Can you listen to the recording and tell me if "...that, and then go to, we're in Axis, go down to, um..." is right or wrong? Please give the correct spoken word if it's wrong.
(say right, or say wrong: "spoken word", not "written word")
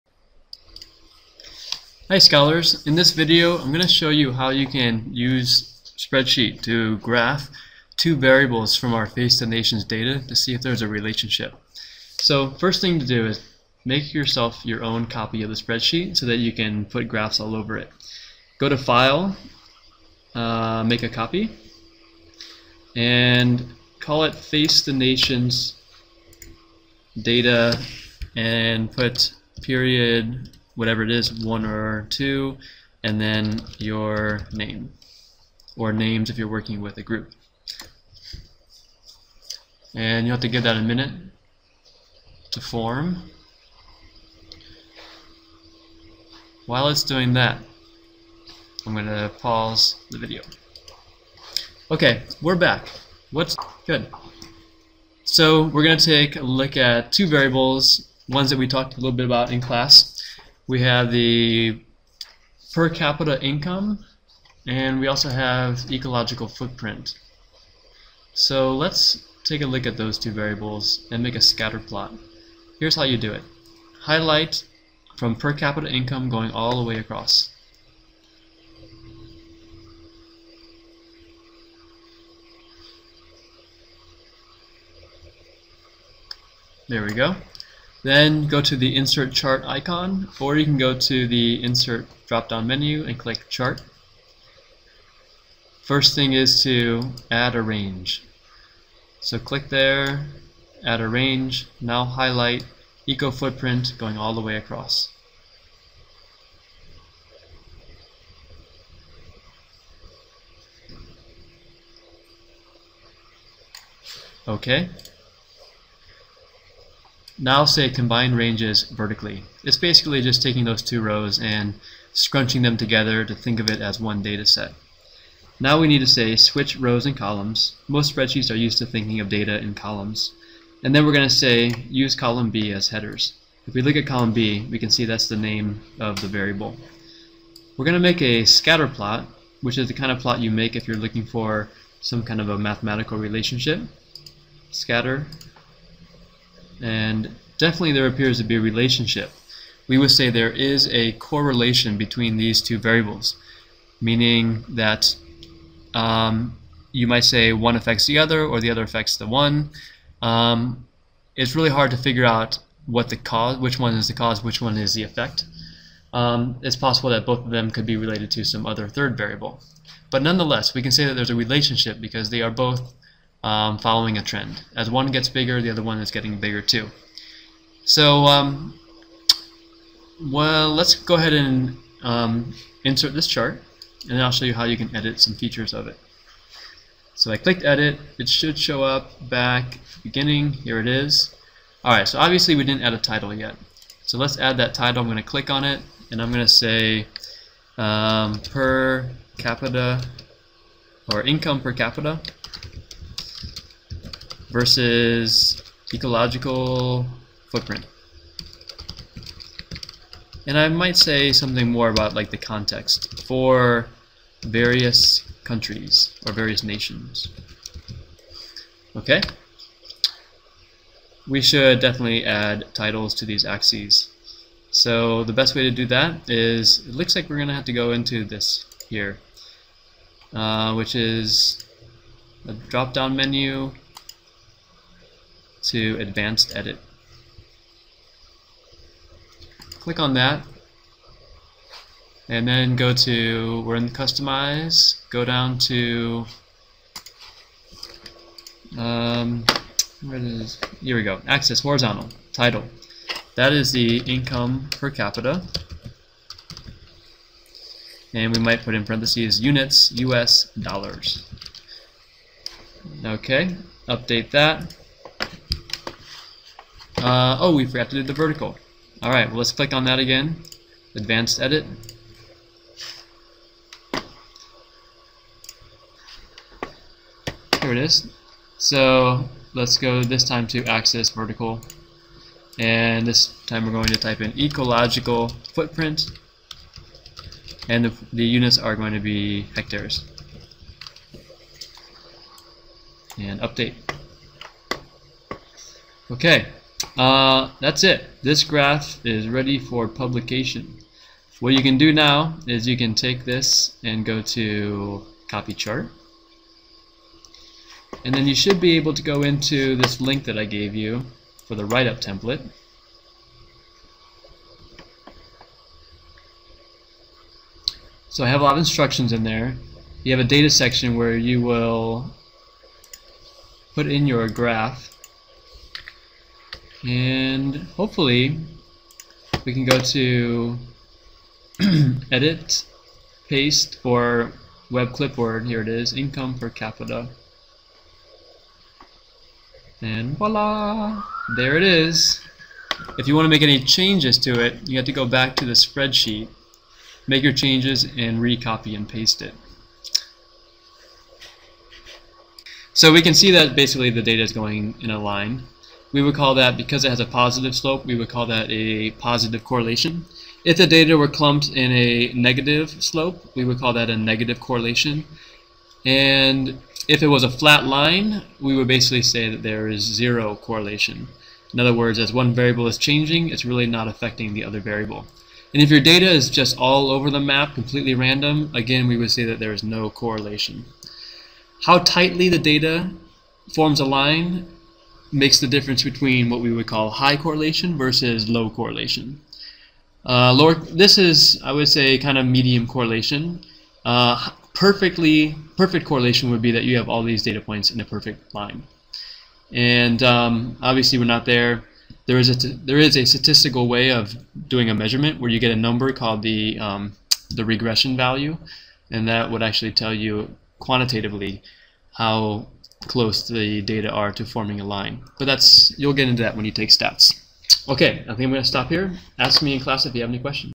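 wrong: "Customize", not "Axis".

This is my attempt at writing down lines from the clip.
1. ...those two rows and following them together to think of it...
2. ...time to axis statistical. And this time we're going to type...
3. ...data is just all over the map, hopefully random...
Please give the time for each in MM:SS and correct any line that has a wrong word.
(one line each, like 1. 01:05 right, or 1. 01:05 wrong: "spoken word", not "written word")
1. 02:00 wrong: "scrunching", not "following"
2. 04:40 wrong: "vertical", not "statistical"
3. 06:15 wrong: "completely", not "hopefully".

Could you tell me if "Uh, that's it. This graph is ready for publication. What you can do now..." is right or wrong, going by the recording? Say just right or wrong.
right.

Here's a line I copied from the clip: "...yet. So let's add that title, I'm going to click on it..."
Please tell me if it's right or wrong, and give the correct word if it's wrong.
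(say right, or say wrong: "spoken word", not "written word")
right.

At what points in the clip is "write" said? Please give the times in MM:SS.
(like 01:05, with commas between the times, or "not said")
05:11.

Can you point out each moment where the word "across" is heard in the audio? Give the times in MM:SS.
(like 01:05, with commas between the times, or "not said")
01:16, 01:44.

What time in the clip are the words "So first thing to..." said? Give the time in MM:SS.
00:12.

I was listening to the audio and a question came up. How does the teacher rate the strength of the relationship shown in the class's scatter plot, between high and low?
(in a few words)
medium correlation.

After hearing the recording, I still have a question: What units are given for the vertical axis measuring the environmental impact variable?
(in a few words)
hectares.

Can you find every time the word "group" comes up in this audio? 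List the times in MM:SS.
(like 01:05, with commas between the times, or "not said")
00:37.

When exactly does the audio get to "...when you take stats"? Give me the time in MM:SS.
06:56.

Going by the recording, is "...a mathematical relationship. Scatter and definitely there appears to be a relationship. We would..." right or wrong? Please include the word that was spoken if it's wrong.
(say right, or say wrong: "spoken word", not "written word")
right.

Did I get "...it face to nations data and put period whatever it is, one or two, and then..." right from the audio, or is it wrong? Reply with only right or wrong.
right.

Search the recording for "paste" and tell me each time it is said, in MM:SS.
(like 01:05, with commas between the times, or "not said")
05:33, 05:48.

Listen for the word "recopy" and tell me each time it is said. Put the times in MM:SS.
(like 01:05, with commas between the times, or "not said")
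05:48.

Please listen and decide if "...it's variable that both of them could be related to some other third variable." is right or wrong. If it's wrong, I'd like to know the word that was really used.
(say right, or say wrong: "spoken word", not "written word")
wrong: "possible", not "variable".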